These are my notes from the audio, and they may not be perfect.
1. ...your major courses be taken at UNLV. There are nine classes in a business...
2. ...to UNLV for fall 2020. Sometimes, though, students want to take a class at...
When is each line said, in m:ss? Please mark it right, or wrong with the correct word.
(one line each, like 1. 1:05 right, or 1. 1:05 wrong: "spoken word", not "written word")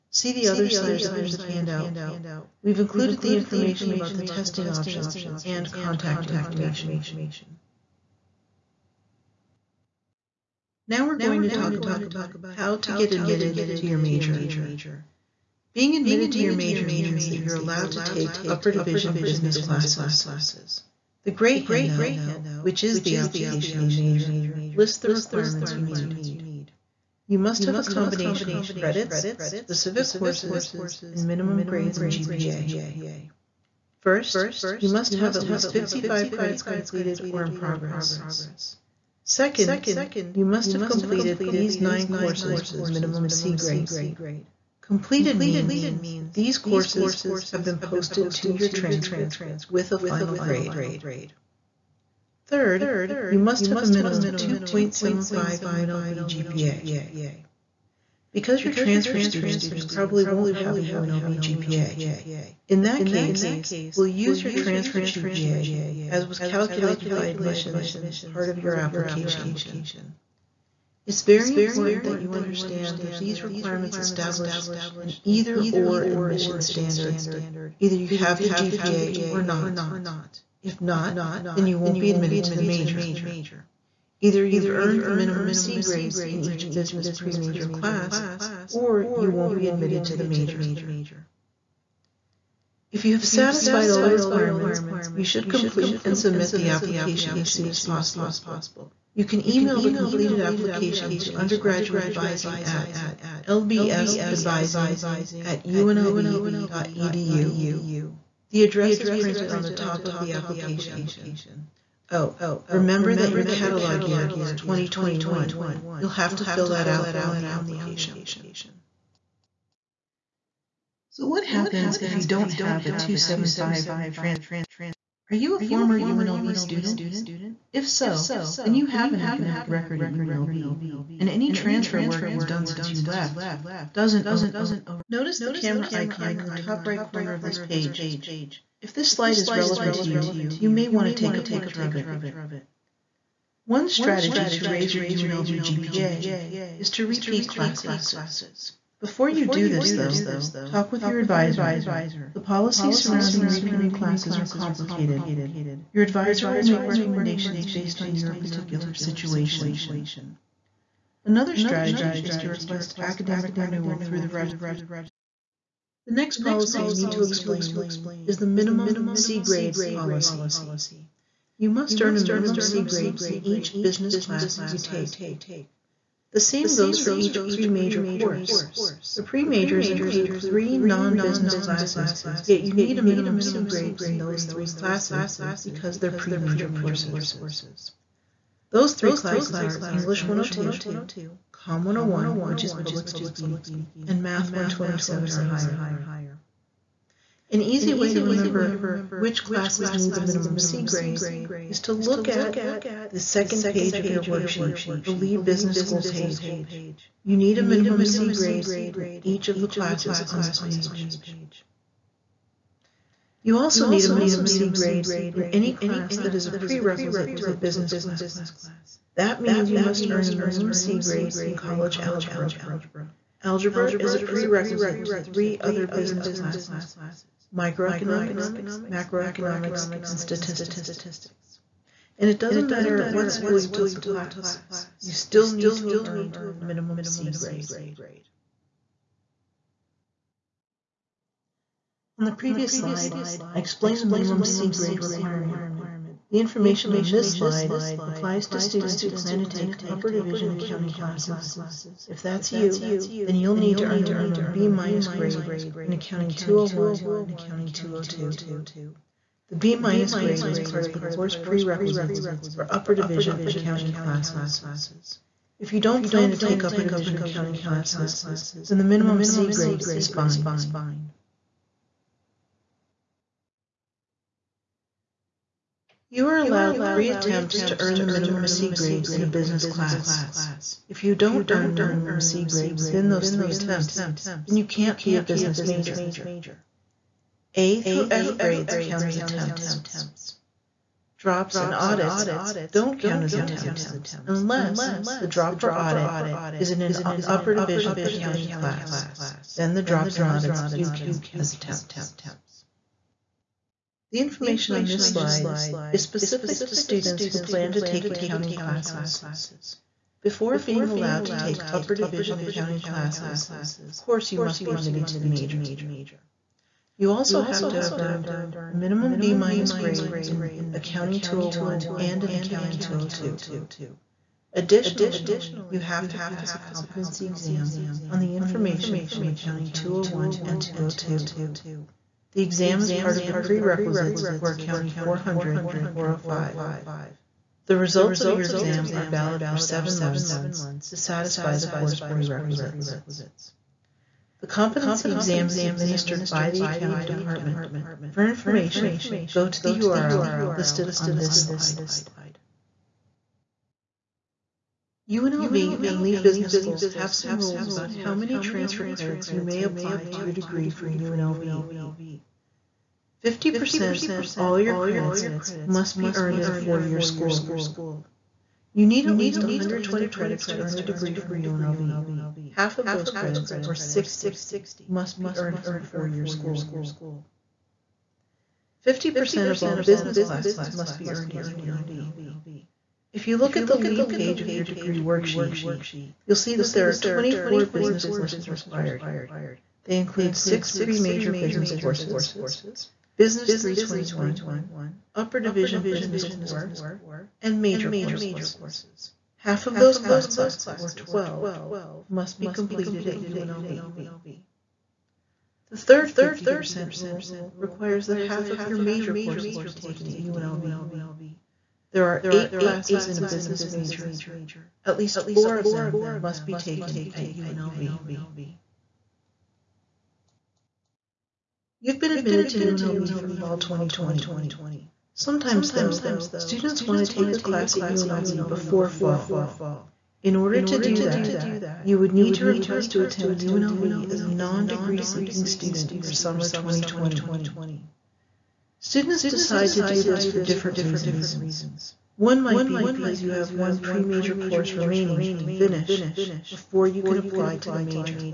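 1. 6:48 wrong: "eight", not "nine"
2. 7:02 right.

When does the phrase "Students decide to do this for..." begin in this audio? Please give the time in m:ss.
7:18.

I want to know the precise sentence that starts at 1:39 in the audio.
You can email the completed application to undergraduateadvising at lbsadvising at unlv.edu.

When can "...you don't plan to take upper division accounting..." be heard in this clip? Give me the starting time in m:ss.
4:25.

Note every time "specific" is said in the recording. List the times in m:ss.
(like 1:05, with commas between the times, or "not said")
0:29, 5:06.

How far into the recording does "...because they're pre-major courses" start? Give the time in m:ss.
3:05.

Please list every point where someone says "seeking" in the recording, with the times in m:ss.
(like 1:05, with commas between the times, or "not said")
7:15.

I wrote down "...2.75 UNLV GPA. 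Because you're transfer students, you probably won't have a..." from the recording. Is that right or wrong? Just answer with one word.
right.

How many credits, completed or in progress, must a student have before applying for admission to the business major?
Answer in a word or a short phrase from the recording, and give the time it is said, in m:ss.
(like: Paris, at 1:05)
55, at 0:35.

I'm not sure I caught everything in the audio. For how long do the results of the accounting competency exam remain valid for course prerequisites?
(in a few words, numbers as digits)
7 months.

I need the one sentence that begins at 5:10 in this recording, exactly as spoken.
Before being allowed to take upper division accounting classes, of course you must be admitted to the major.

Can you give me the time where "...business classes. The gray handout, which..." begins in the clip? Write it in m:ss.
0:19.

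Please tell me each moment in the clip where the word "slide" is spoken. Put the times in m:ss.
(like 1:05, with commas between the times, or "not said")
2:19, 4:02, 4:07, 5:05, 5:51.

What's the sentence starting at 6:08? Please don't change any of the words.
You need at least 120 credits to earn a degree from UNLV.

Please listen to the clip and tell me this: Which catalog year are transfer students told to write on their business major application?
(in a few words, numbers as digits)
2021.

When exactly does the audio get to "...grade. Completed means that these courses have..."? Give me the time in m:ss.
0:43.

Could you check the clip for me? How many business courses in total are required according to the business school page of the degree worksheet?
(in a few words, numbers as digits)
24.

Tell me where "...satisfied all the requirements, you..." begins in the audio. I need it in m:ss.
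1:33.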